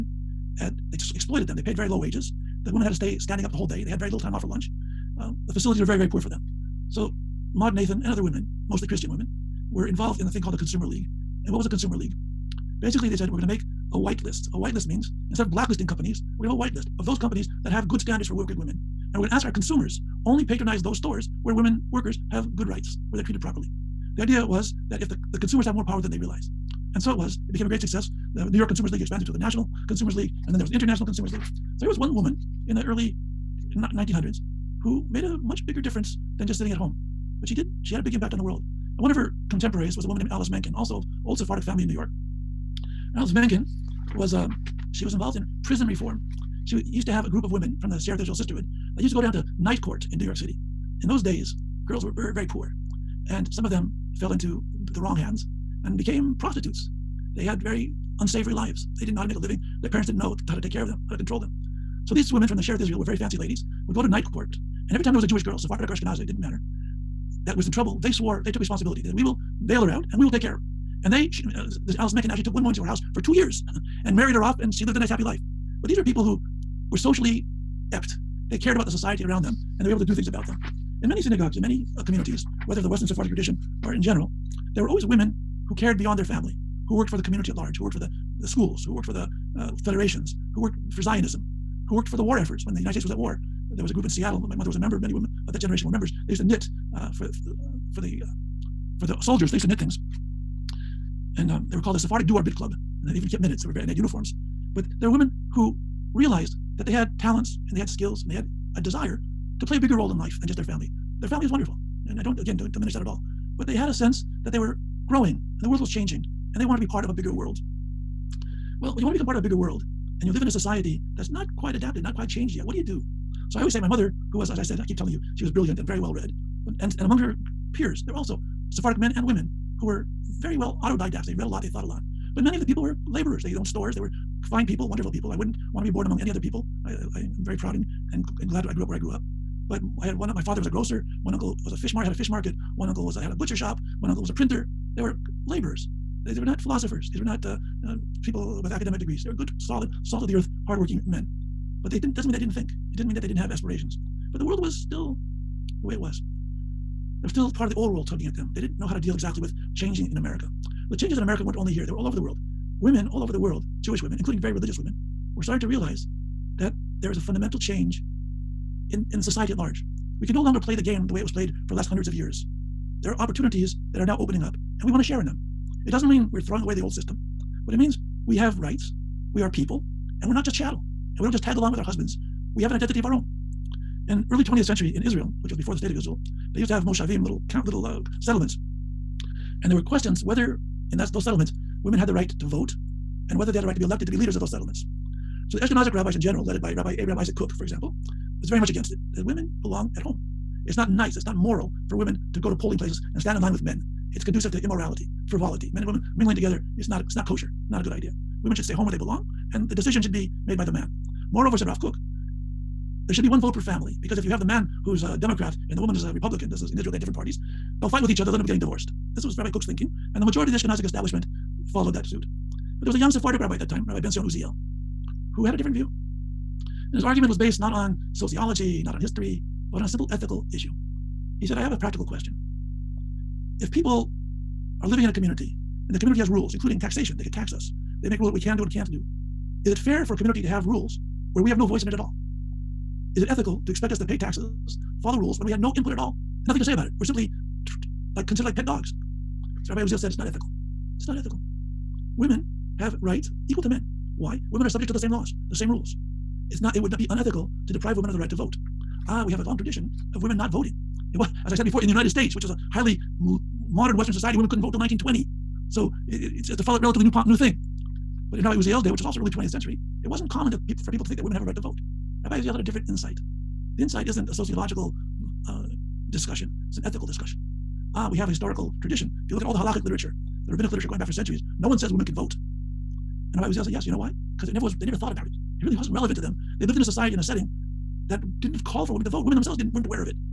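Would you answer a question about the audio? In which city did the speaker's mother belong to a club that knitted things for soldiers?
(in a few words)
Seattle.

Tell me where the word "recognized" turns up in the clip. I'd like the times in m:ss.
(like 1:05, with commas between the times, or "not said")
not said.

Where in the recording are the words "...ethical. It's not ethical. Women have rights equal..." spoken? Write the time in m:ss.
4:10.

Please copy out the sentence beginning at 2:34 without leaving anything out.
But the world was still the way it was.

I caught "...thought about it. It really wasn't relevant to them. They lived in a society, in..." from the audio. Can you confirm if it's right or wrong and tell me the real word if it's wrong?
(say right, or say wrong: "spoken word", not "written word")
right.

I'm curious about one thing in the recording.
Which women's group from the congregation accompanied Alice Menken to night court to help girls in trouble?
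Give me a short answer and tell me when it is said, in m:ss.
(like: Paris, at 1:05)
Sacerdotal Sisterhood, at 0:47.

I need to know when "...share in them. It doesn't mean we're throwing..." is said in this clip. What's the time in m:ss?
2:55.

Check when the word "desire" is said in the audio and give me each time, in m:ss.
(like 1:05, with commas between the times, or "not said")
1:48.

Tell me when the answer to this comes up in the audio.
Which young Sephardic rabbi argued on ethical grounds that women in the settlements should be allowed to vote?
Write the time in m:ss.
3:43.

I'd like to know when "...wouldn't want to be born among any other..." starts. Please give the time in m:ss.
2:15.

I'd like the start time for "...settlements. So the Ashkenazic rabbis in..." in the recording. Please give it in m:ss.
3:14.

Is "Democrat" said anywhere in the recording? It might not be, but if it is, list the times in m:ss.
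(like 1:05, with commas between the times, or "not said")
3:35.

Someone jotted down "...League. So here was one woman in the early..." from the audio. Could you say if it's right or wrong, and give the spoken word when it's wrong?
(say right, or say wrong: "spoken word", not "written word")
right.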